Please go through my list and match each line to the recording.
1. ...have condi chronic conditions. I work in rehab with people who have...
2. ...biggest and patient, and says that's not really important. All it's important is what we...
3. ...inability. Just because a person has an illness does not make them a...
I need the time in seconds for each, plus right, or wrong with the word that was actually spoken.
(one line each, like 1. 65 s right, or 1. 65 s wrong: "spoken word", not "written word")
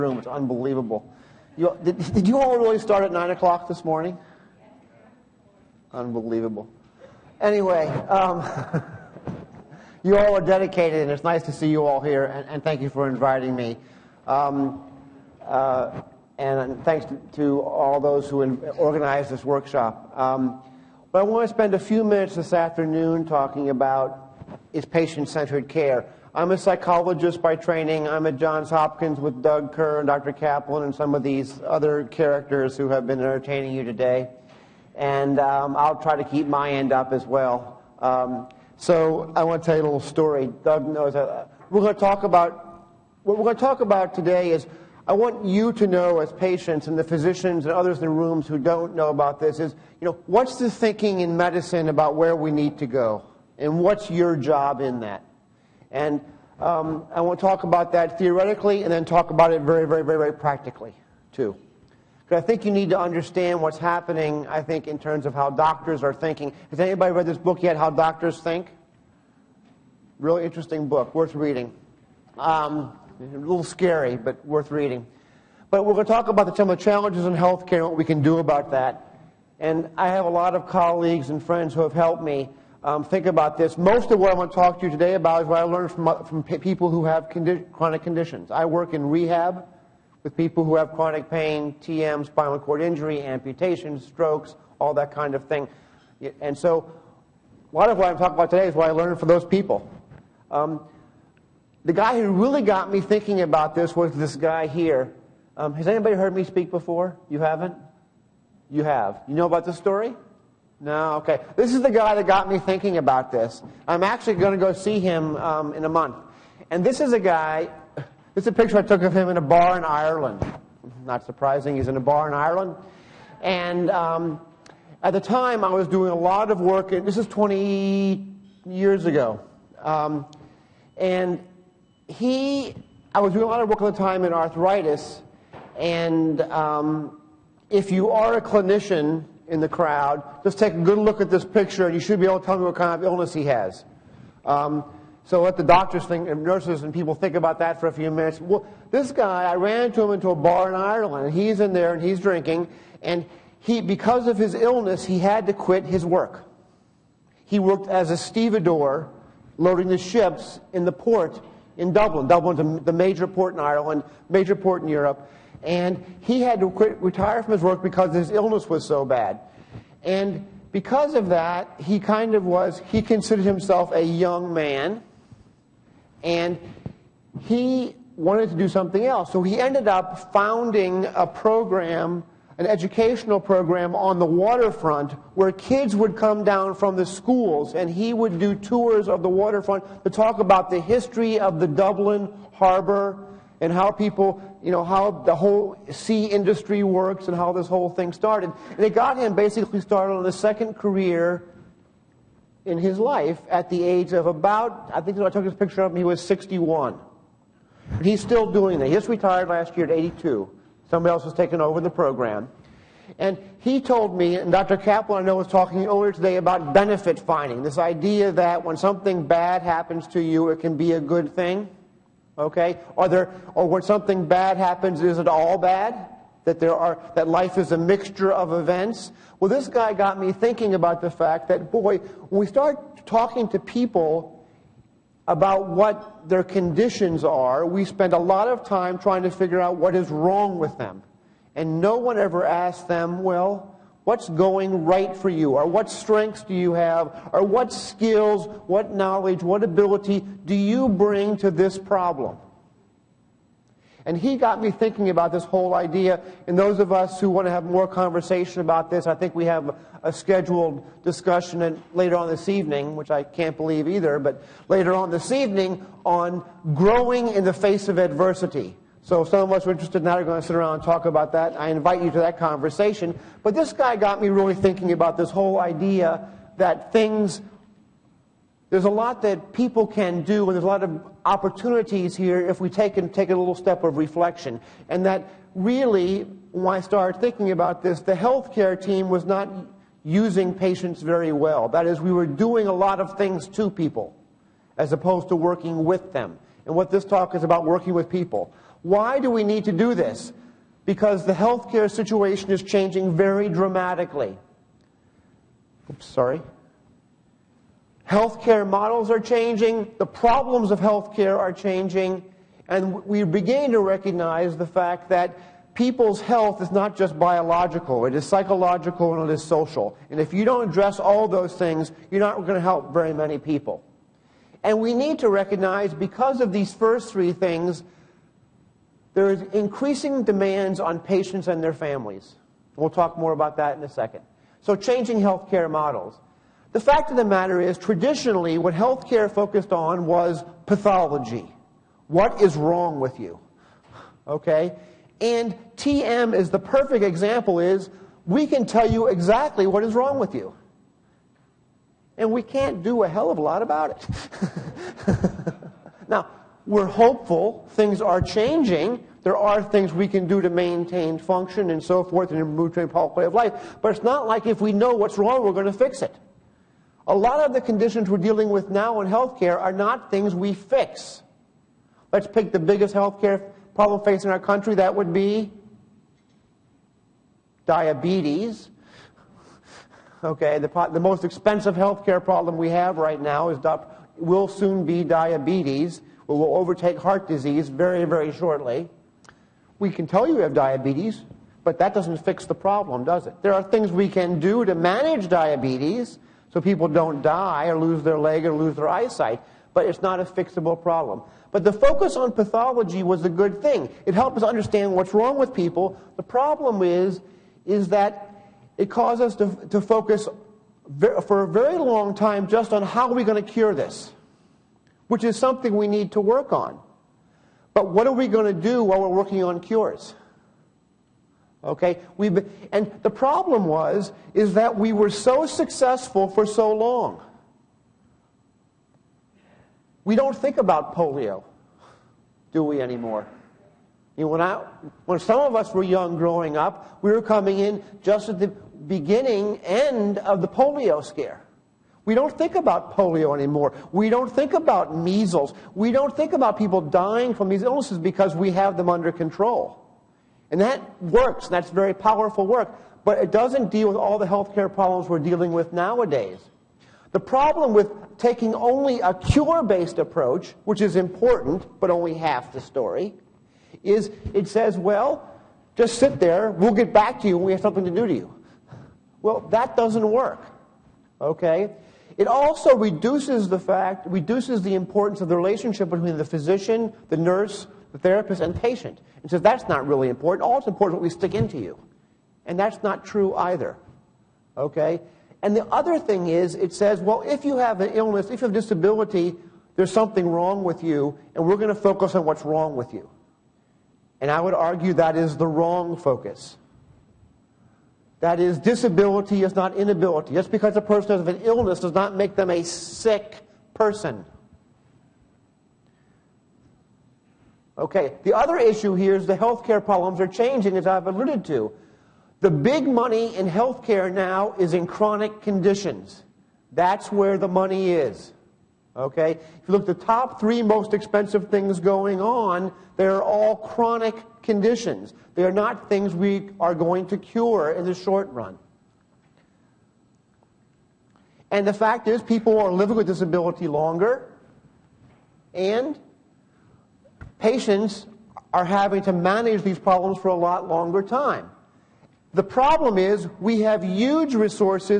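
1. 87 s right
2. 478 s wrong: "therapist", not "biggest"
3. 499 s right.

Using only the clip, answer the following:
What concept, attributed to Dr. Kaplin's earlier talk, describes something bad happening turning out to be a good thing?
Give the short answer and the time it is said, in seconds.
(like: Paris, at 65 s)
Benefit finding, at 216 s.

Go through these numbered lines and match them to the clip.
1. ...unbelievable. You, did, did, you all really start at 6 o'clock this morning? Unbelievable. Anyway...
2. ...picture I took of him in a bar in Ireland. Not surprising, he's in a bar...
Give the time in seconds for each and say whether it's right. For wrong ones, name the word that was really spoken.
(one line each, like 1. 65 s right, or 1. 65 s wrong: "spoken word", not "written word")
1. 0 s wrong: "9", not "6"
2. 118 s right.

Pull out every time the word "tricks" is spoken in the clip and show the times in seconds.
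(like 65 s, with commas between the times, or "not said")
not said.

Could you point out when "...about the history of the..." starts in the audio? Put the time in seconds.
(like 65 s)
190 s.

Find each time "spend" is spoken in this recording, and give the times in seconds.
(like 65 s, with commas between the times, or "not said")
21 s, 237 s.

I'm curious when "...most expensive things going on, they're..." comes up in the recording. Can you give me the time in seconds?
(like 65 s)
520 s.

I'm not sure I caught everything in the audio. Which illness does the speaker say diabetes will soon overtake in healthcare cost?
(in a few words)
Heart disease.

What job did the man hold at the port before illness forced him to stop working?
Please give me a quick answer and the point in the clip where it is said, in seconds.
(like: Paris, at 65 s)
Stevedore, at 158 s.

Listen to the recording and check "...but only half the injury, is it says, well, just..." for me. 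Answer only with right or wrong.
wrong.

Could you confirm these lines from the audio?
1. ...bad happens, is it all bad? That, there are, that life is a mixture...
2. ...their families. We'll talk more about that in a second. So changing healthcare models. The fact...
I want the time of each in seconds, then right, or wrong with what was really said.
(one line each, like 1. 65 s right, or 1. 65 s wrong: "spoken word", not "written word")
1. 224 s right
2. 331 s right.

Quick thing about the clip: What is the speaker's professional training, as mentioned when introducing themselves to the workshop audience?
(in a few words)
Psychologist.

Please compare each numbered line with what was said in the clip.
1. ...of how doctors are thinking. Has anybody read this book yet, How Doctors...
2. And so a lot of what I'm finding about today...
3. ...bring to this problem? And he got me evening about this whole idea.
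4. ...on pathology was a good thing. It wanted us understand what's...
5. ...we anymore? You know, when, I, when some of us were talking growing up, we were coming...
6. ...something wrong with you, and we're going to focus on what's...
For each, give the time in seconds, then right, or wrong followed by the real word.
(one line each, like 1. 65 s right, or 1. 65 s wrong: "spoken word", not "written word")
1. 65 s right
2. 96 s wrong: "talking", not "finding"
3. 250 s wrong: "thinking", not "evening"
4. 402 s wrong: "helped", not "wanted"
5. 432 s wrong: "young", not "talking"
6. 489 s right.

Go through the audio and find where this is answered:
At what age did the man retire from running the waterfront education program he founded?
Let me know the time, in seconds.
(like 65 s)
209 s.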